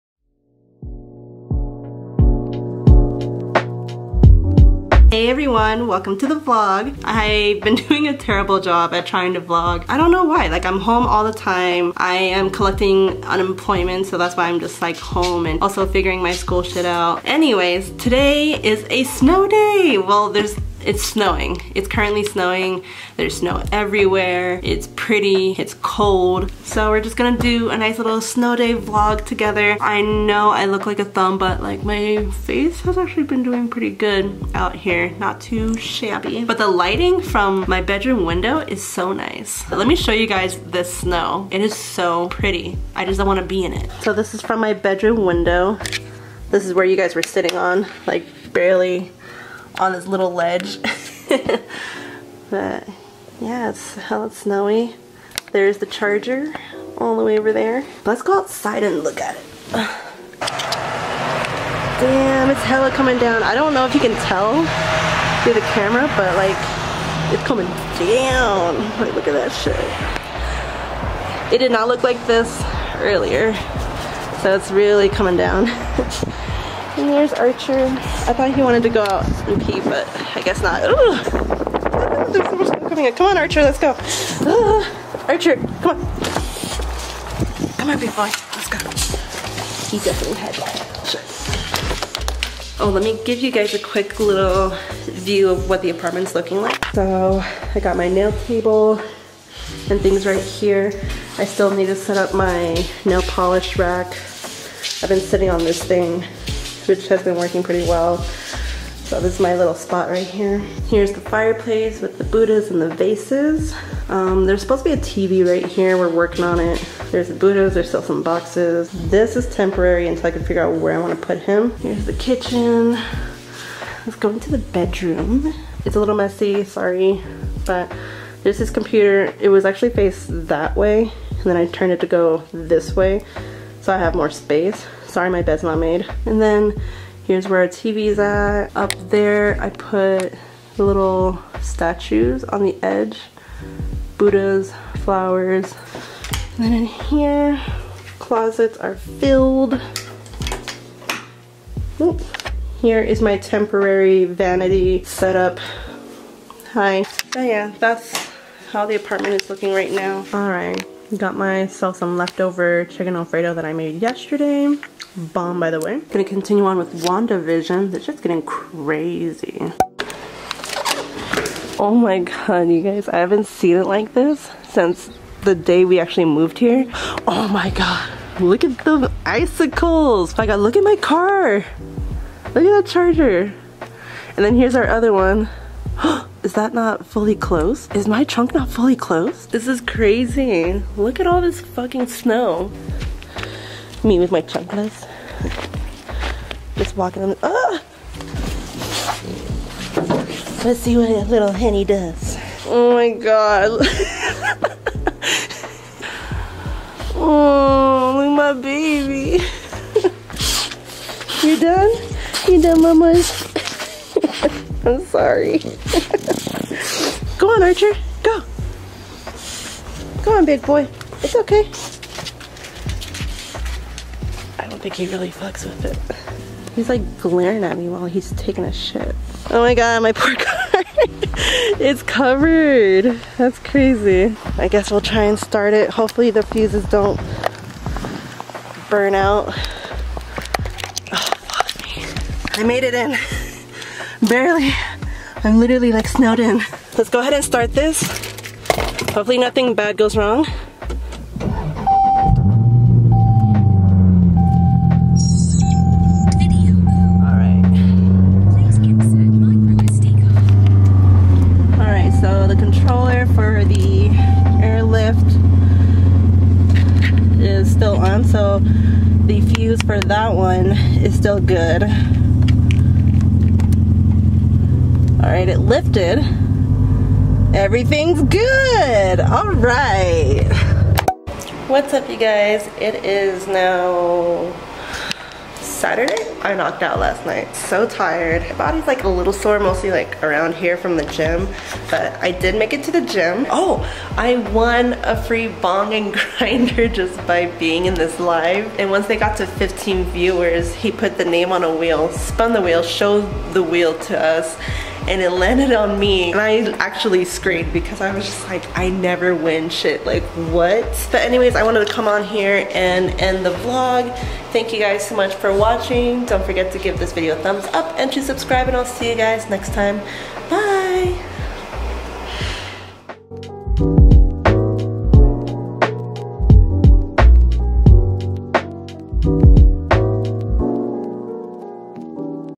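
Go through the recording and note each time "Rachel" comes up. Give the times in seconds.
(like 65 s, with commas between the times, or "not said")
not said.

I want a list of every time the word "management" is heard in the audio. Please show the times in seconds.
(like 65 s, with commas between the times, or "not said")
not said.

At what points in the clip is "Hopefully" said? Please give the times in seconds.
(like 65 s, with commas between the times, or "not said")
235 s, 249 s.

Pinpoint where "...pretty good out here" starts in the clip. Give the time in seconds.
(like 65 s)
33 s.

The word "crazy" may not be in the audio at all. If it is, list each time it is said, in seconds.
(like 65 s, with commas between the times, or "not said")
168 s, 189 s, 233 s.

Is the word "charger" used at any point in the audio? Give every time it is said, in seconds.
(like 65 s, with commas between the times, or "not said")
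55 s, 182 s.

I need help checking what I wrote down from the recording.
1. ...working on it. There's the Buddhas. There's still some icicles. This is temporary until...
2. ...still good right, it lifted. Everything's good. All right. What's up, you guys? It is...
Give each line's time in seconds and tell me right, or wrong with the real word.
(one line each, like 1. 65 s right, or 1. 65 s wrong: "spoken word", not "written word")
1. 116 s wrong: "boxes", not "icicles"
2. 271 s right.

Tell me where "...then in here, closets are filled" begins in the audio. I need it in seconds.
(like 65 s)
146 s.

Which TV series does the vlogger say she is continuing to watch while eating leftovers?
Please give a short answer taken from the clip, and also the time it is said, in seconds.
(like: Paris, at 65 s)
WandaVision, at 167 s.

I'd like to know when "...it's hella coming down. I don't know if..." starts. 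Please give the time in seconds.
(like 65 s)
62 s.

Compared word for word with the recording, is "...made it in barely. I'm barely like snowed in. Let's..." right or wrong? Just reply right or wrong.
wrong.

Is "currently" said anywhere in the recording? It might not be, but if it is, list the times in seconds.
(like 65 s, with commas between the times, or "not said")
21 s.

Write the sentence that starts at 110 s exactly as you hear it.
Here's the fireplace with the Buddhas and the vases.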